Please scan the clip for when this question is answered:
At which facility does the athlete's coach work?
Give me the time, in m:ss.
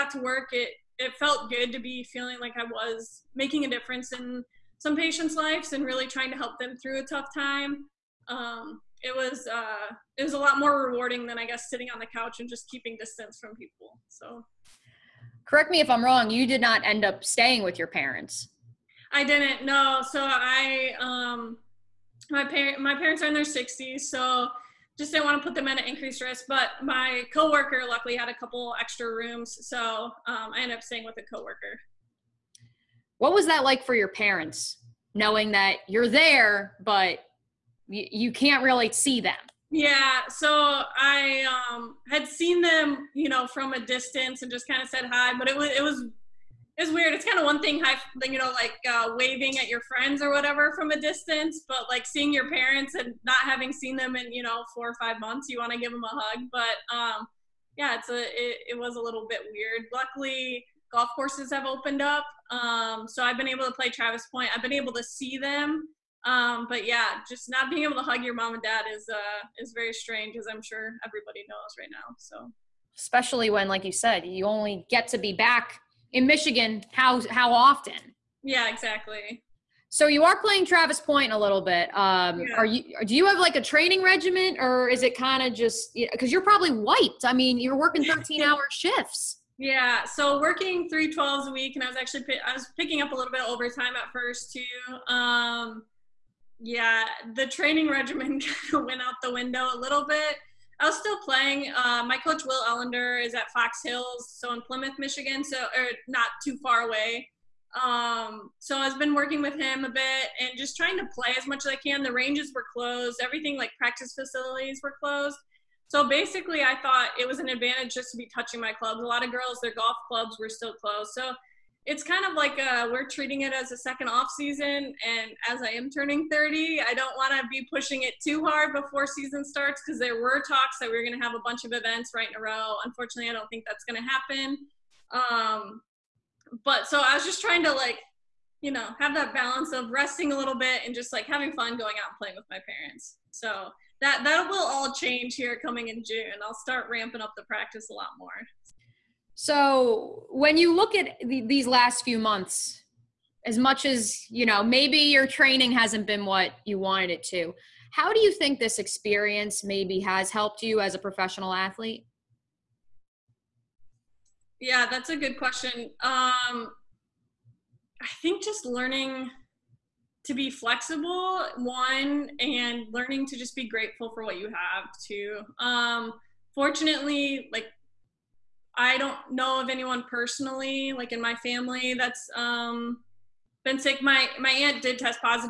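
1:43.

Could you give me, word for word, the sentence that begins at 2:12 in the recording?
Unfortunately, I don't think that's going to happen.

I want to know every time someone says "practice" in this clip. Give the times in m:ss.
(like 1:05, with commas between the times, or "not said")
1:53, 2:27.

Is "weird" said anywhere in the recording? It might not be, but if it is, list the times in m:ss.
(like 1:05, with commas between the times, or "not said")
0:46, 0:59.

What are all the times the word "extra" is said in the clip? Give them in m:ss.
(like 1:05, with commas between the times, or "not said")
0:28.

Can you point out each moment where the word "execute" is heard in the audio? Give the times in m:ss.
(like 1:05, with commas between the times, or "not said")
not said.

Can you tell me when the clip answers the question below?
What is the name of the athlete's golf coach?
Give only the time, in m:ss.
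1:42.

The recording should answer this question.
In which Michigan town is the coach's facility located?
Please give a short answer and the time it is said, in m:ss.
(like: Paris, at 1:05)
Plymouth, at 1:44.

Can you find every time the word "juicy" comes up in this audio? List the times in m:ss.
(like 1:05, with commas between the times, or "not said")
not said.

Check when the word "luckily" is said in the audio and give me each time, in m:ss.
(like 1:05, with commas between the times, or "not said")
0:27, 0:59.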